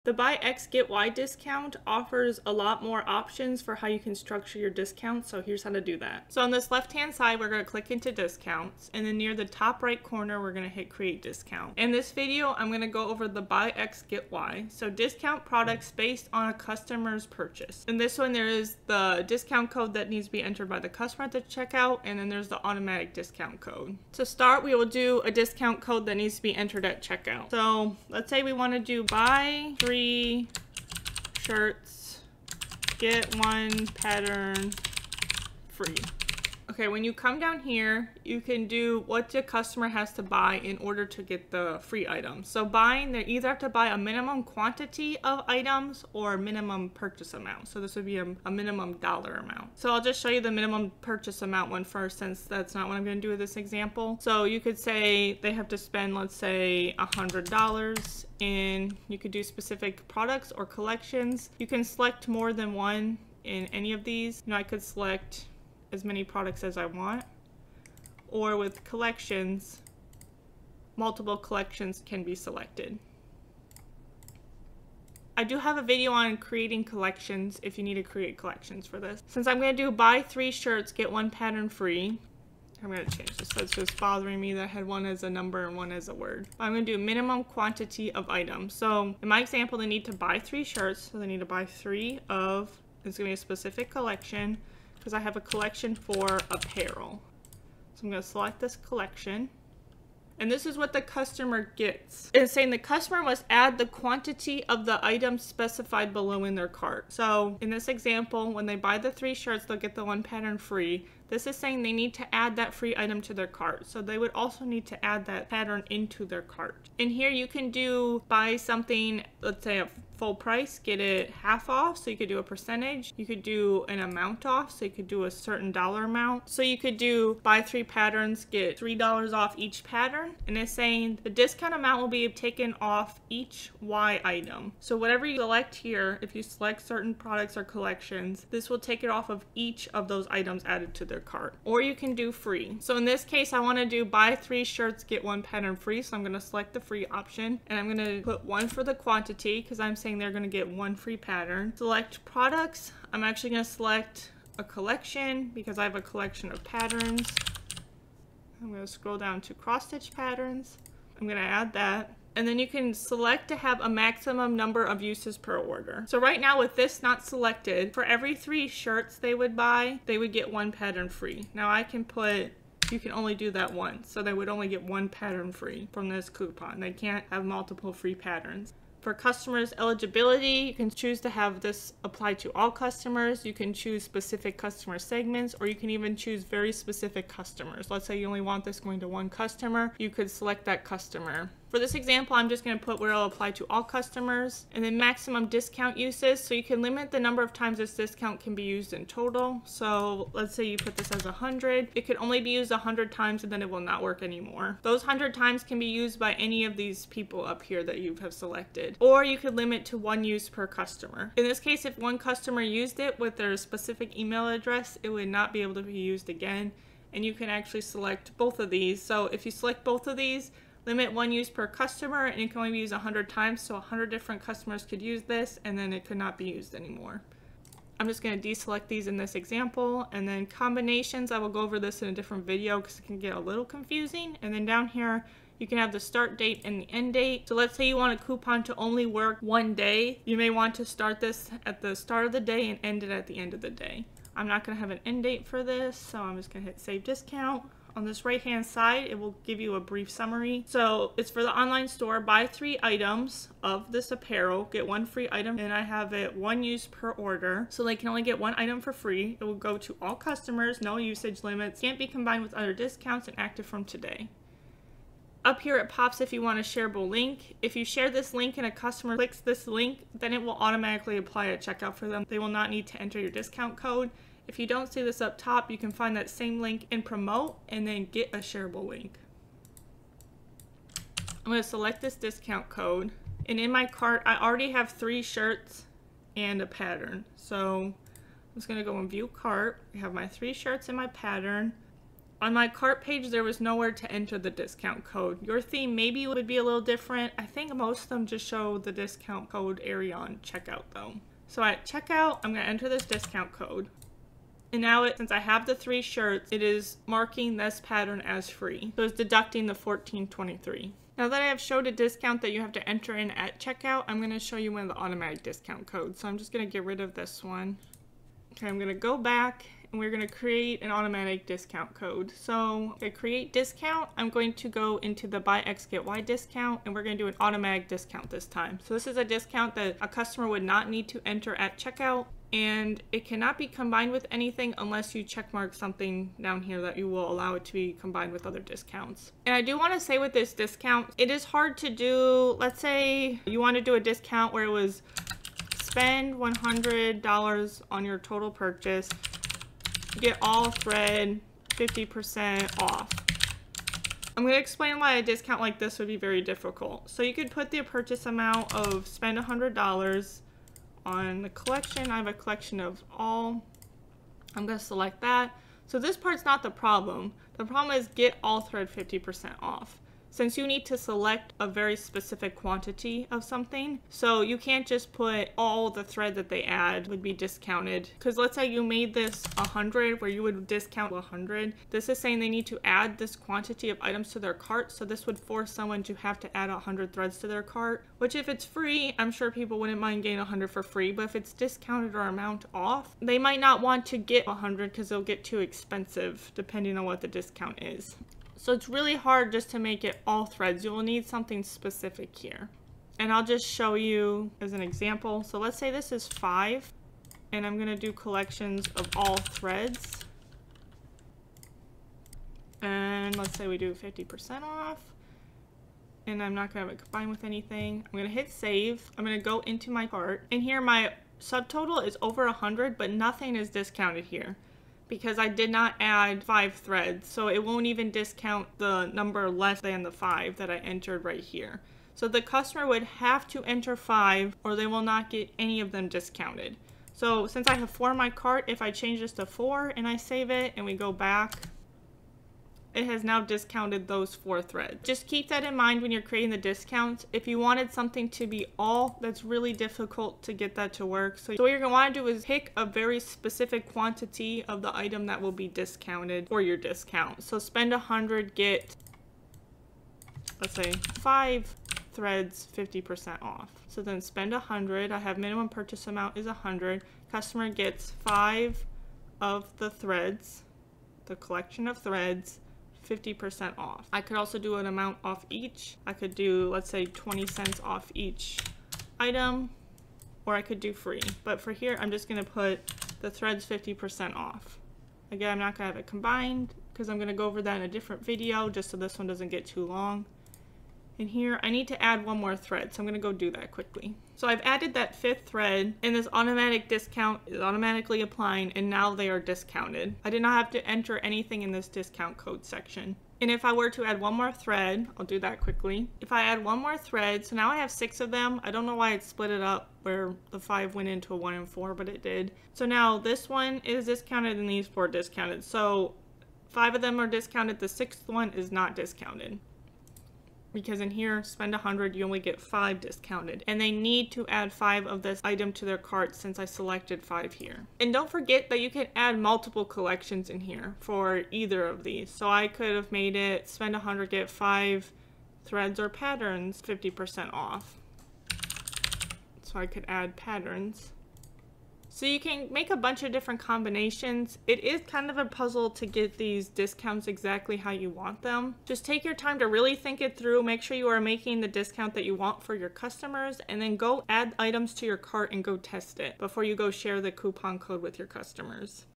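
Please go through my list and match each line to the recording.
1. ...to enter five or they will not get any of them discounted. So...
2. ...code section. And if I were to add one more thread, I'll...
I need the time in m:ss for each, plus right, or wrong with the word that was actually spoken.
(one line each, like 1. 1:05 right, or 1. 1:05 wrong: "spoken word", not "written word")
1. 7:13 right
2. 8:22 right.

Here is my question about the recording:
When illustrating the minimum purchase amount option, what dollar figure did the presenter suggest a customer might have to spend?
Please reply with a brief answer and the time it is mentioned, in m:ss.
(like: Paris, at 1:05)
$100, at 0:56.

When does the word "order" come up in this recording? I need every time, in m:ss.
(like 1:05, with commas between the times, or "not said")
0:40, 2:45, 4:17.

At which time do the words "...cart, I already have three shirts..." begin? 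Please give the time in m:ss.
4:43.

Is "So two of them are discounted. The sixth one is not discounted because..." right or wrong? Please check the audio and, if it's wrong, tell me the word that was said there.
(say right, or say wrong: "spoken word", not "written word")
wrong: "five", not "two".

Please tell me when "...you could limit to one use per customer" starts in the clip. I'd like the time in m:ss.
3:29.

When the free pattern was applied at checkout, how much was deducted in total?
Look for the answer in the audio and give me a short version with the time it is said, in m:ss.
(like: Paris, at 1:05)
14.23, at 5:09.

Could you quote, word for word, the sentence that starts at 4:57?
I think most of them just show the discount code area on checkout though.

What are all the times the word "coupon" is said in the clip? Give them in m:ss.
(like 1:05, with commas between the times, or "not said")
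2:56, 3:58, 9:17.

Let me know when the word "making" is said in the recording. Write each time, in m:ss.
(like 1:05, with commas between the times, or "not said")
9:11.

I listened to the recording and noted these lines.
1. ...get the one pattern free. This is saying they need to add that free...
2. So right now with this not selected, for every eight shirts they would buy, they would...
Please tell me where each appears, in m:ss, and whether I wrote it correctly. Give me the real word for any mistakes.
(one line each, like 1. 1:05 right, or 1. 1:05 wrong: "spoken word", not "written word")
1. 1:49 right
2. 2:46 wrong: "three", not "eight".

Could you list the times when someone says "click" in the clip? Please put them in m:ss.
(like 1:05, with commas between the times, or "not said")
0:07, 4:29.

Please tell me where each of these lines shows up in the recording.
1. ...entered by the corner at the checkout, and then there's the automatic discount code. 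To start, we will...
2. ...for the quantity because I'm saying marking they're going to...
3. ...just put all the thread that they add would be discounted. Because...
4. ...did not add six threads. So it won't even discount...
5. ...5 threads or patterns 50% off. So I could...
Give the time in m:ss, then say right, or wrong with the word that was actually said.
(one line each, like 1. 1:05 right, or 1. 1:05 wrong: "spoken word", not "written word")
1. 0:20 wrong: "customer", not "corner"
2. 2:28 wrong: "saying", not "marking"
3. 6:14 right
4. 7:05 wrong: "five", not "six"
5. 8:54 right.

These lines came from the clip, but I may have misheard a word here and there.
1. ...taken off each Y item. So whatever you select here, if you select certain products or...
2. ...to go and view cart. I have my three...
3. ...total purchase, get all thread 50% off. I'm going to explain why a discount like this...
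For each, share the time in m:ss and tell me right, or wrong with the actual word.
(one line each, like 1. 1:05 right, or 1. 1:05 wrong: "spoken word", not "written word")
1. 2:12 right
2. 4:48 right
3. 5:48 right.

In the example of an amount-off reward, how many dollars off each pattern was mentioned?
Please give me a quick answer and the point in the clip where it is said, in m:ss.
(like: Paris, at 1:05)
$3, at 2:08.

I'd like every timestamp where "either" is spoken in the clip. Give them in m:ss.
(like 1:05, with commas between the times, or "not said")
0:43, 8:51.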